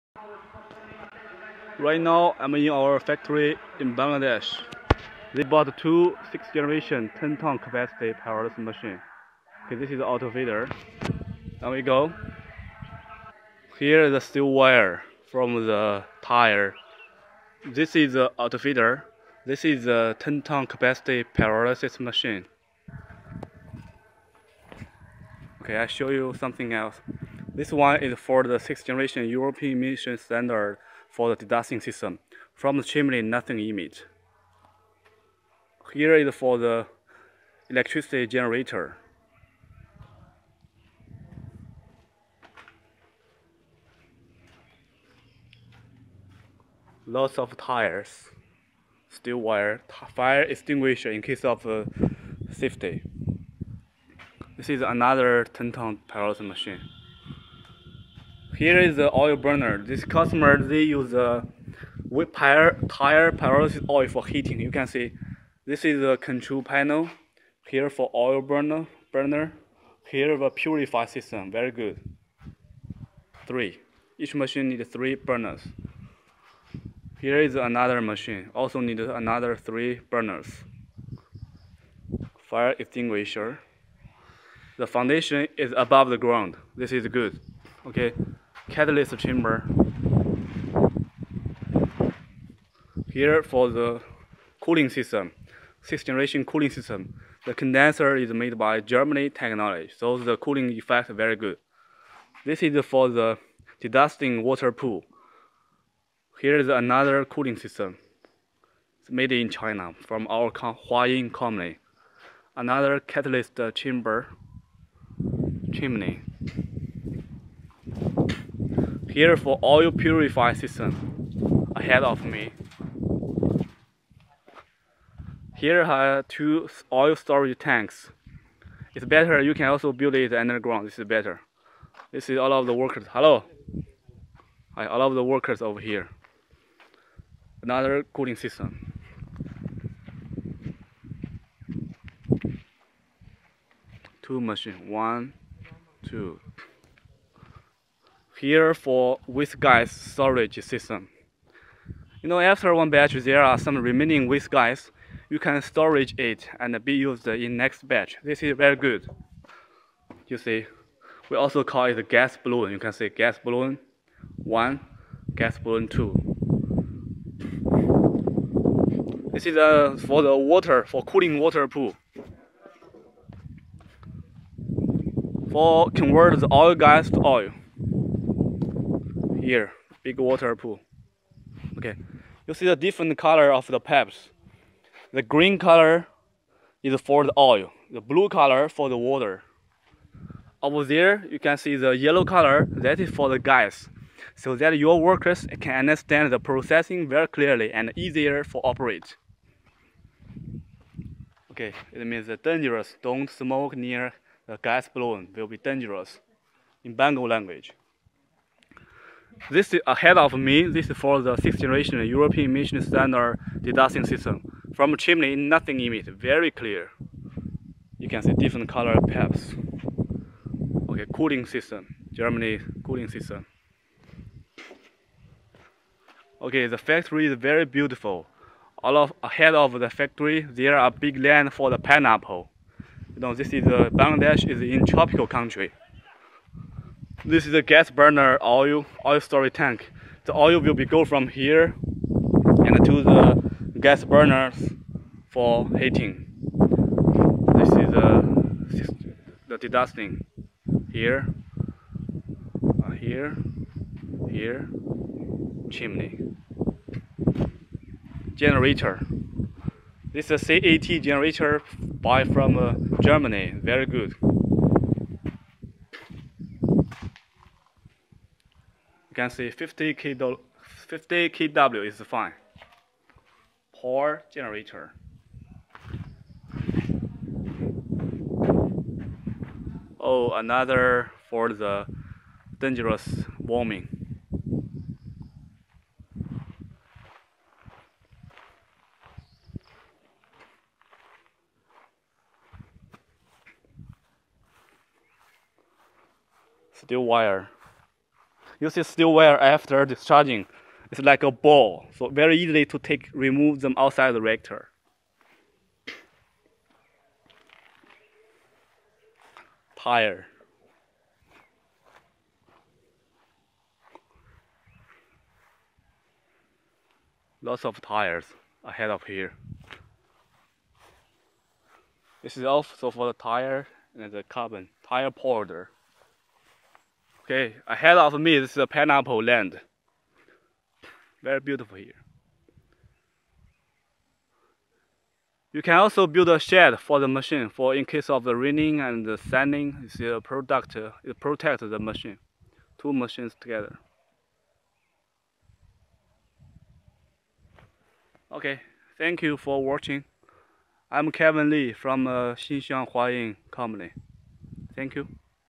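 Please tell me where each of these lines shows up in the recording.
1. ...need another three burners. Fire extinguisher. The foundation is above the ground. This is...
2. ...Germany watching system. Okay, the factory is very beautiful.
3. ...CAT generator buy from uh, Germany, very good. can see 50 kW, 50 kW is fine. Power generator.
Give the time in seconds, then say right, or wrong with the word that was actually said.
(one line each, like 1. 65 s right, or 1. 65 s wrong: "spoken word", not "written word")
1. 78 s right
2. 222 s wrong: "cooling", not "watching"
3. 260 s right.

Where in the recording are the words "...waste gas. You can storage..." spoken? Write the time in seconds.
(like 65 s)
154 s.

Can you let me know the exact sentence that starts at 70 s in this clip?
Here the purify system, very good.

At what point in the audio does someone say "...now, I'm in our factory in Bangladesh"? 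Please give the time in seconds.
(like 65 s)
1 s.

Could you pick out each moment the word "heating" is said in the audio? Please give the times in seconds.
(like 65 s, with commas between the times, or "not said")
64 s, 245 s.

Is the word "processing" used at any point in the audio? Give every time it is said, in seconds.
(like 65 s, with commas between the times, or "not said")
196 s.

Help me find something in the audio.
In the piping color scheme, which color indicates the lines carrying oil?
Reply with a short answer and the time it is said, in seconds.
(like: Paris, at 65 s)
Green, at 185 s.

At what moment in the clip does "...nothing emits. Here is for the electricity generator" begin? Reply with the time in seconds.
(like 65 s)
33 s.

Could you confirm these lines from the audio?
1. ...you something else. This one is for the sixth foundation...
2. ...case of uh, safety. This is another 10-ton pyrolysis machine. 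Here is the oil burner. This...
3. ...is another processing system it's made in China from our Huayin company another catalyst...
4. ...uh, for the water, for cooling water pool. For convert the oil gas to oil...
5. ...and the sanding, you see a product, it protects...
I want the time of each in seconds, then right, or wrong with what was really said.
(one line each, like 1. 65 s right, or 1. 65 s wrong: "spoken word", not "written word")
1. 26 s wrong: "generation", not "foundation"
2. 51 s right
3. 106 s wrong: "cooling", not "processing"
4. 169 s right
5. 338 s right.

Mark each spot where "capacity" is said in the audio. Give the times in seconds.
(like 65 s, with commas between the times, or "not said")
7 s, 20 s.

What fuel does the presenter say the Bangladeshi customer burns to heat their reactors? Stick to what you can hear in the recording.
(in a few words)
Tire pyrolysis oil.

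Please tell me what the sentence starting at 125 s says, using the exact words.
Here are two oil storage tanks.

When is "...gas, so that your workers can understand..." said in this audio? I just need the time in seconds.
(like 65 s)
193 s.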